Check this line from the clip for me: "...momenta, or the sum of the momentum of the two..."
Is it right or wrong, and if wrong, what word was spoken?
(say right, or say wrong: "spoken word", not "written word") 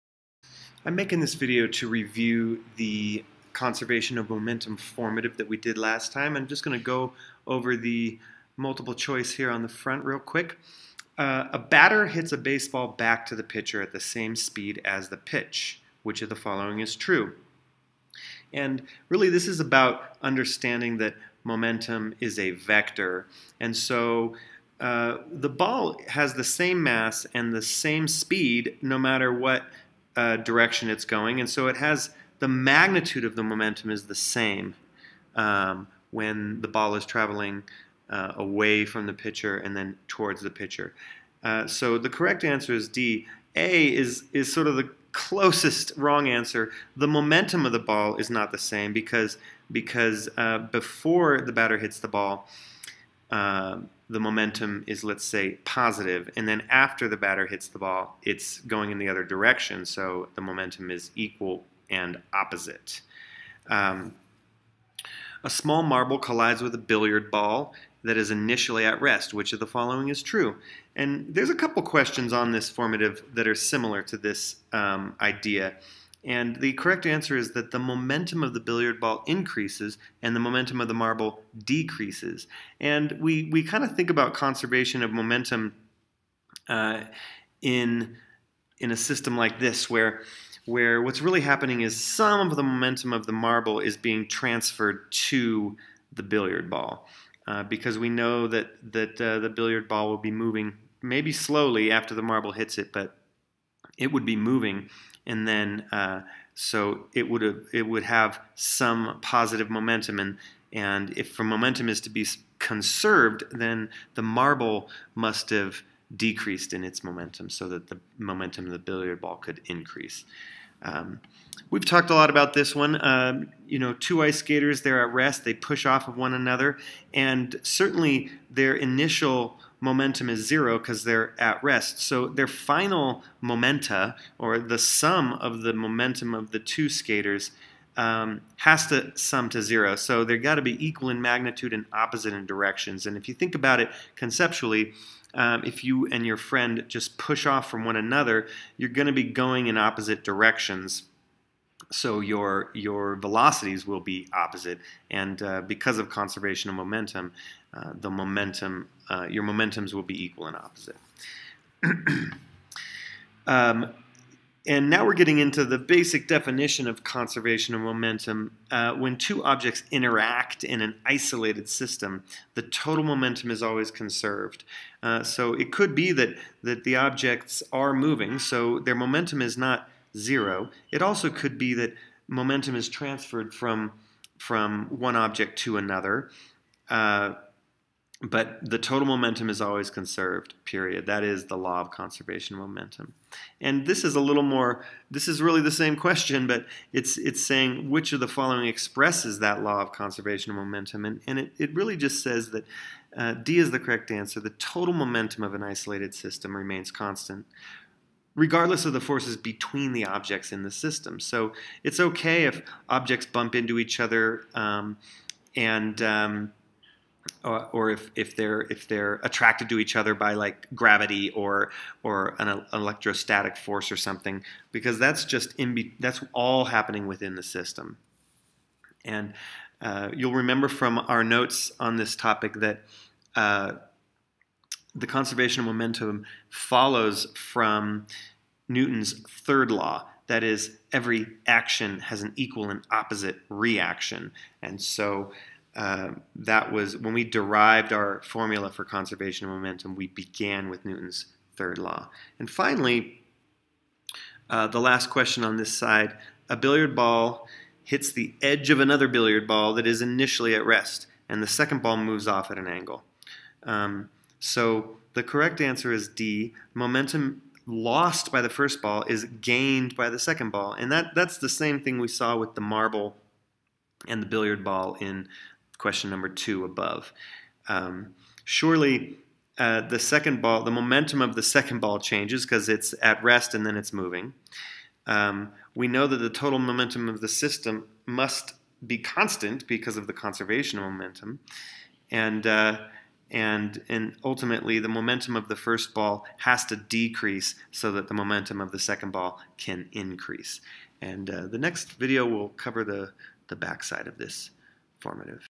right.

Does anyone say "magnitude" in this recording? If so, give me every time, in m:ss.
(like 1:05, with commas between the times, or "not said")
0:32, 2:21.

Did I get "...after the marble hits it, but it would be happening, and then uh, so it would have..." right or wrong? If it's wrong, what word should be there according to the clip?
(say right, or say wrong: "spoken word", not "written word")
wrong: "moving", not "happening".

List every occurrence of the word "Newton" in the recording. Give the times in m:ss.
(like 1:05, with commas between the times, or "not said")
3:58, 4:10.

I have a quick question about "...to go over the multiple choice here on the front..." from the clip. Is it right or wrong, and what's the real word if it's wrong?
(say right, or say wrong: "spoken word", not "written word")
right.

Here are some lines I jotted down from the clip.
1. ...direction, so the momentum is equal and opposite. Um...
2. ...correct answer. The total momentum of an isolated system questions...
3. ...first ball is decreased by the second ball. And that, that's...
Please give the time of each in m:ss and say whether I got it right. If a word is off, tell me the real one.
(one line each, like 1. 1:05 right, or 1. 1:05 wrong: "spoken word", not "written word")
1. 0:59 right
2. 3:23 wrong: "remains", not "questions"
3. 4:28 wrong: "gained", not "decreased".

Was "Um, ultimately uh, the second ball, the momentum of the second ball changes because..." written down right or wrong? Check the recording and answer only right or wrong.
wrong.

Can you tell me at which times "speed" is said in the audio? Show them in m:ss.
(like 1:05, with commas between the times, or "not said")
0:14, 0:28.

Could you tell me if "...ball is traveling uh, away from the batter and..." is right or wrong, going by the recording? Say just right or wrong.
wrong.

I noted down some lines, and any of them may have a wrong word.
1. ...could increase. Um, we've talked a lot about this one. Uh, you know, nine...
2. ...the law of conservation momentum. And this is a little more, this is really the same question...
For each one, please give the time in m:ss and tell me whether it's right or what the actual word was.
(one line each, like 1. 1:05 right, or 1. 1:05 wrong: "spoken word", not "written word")
1. 1:59 wrong: "two", not "nine"
2. 3:11 right.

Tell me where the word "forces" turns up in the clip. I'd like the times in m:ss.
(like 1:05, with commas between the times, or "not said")
3:28, 3:43.